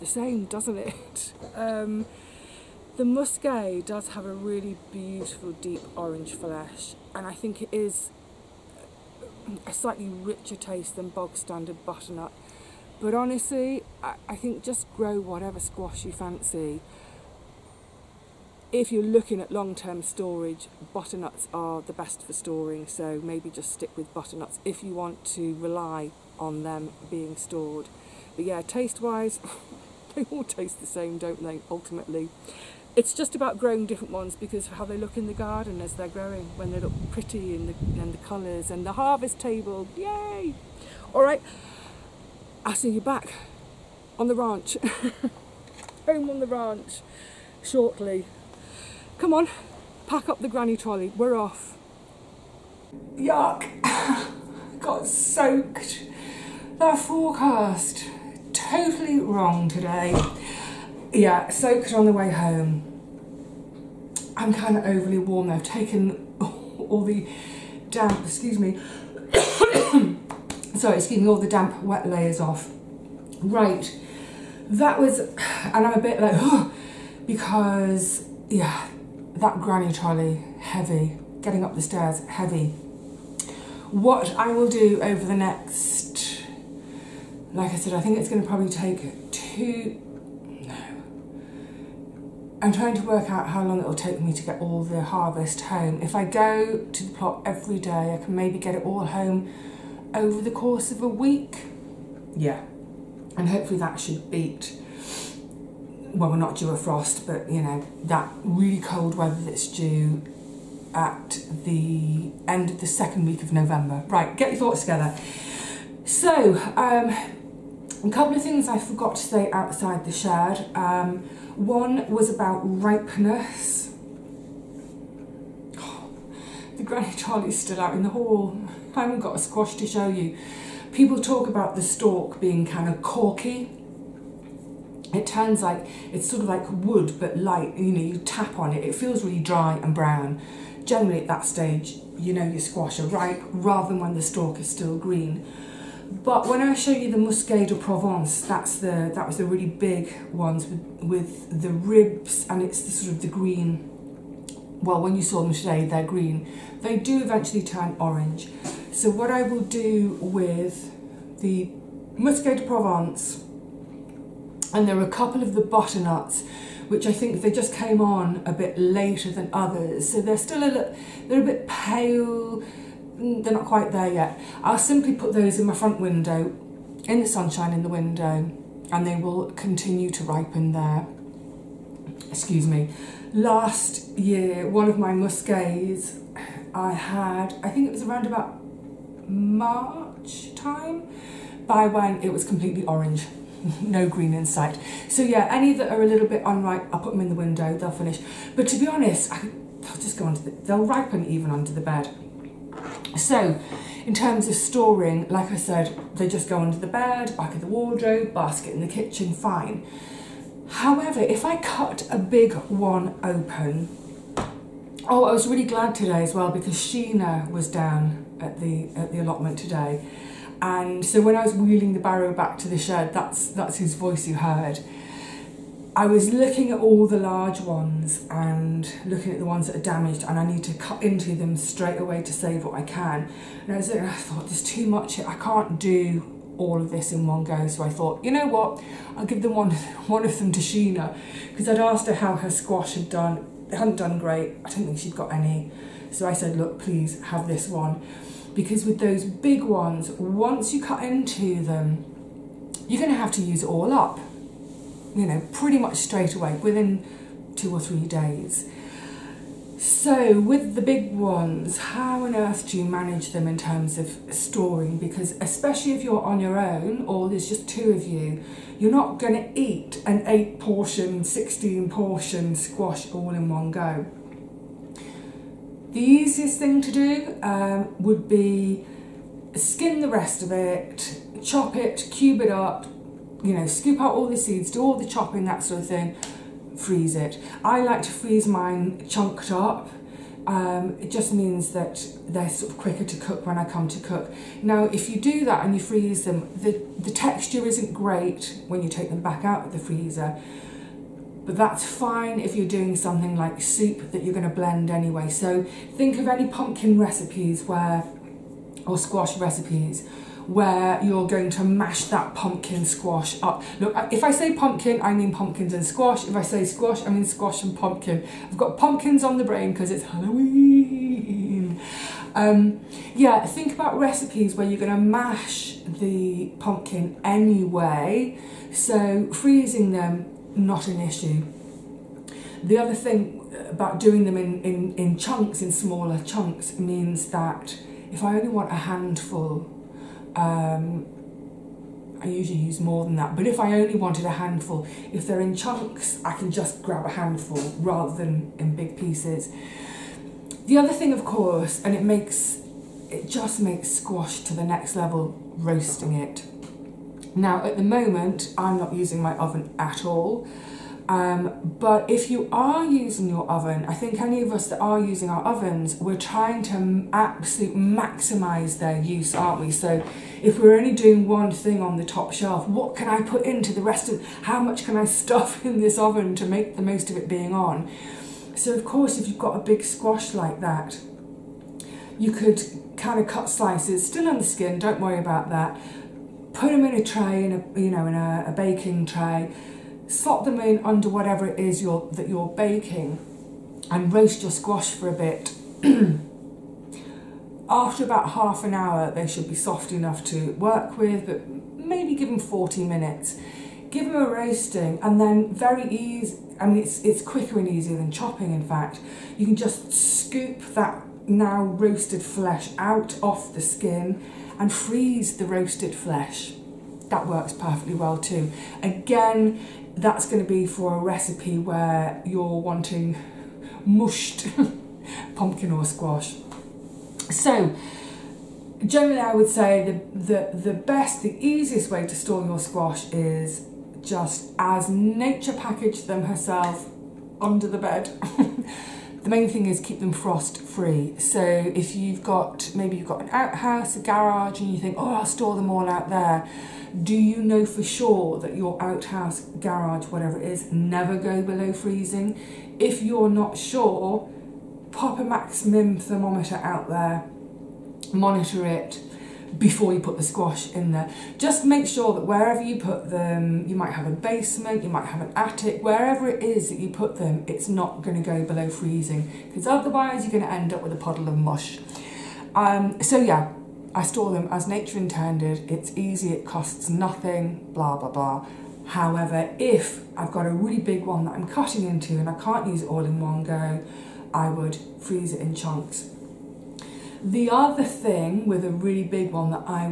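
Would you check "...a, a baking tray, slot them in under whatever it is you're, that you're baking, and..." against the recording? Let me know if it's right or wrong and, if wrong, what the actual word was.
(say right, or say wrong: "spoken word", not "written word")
right.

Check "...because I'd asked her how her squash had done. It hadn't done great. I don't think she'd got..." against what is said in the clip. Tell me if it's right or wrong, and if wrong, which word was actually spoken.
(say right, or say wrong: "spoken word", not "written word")
right.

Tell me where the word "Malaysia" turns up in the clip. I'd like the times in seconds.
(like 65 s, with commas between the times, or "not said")
not said.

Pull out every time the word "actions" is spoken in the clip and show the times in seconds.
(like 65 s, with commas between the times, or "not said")
not said.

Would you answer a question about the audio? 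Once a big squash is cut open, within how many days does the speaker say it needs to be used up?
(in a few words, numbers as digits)
2 or 3 days.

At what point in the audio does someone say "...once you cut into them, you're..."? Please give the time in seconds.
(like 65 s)
250 s.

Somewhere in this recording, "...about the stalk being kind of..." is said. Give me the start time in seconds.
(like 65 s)
131 s.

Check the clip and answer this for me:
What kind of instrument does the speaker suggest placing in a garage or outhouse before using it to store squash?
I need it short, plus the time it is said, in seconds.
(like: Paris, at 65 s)
A maximum thermometer, at 455 s.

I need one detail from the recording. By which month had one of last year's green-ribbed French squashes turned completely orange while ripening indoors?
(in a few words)
March.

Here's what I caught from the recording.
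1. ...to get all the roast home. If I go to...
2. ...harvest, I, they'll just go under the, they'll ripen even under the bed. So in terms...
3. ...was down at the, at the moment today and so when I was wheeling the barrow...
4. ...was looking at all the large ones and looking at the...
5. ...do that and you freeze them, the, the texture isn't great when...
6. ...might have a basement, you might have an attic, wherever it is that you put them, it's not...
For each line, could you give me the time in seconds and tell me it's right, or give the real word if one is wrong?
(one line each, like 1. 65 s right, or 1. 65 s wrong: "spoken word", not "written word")
1. 94 s wrong: "harvest", not "roast"
2. 198 s wrong: "honest", not "harvest"
3. 217 s wrong: "allotment", not "moment"
4. 226 s right
5. 295 s right
6. 463 s right.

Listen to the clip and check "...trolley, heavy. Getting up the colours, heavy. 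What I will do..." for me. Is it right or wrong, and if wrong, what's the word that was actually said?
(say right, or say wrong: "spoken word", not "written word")
wrong: "stairs", not "colours".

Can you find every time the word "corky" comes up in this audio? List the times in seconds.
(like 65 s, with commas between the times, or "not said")
133 s.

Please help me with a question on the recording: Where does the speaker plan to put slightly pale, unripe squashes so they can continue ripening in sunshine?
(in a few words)
Front window.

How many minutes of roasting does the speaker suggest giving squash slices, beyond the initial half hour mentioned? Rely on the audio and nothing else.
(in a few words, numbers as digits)
40 minutes.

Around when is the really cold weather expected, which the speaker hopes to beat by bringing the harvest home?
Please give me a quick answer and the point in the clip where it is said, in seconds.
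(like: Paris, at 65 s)
Second week of November, at 112 s.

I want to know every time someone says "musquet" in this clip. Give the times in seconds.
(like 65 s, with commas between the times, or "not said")
3 s, 147 s, 162 s.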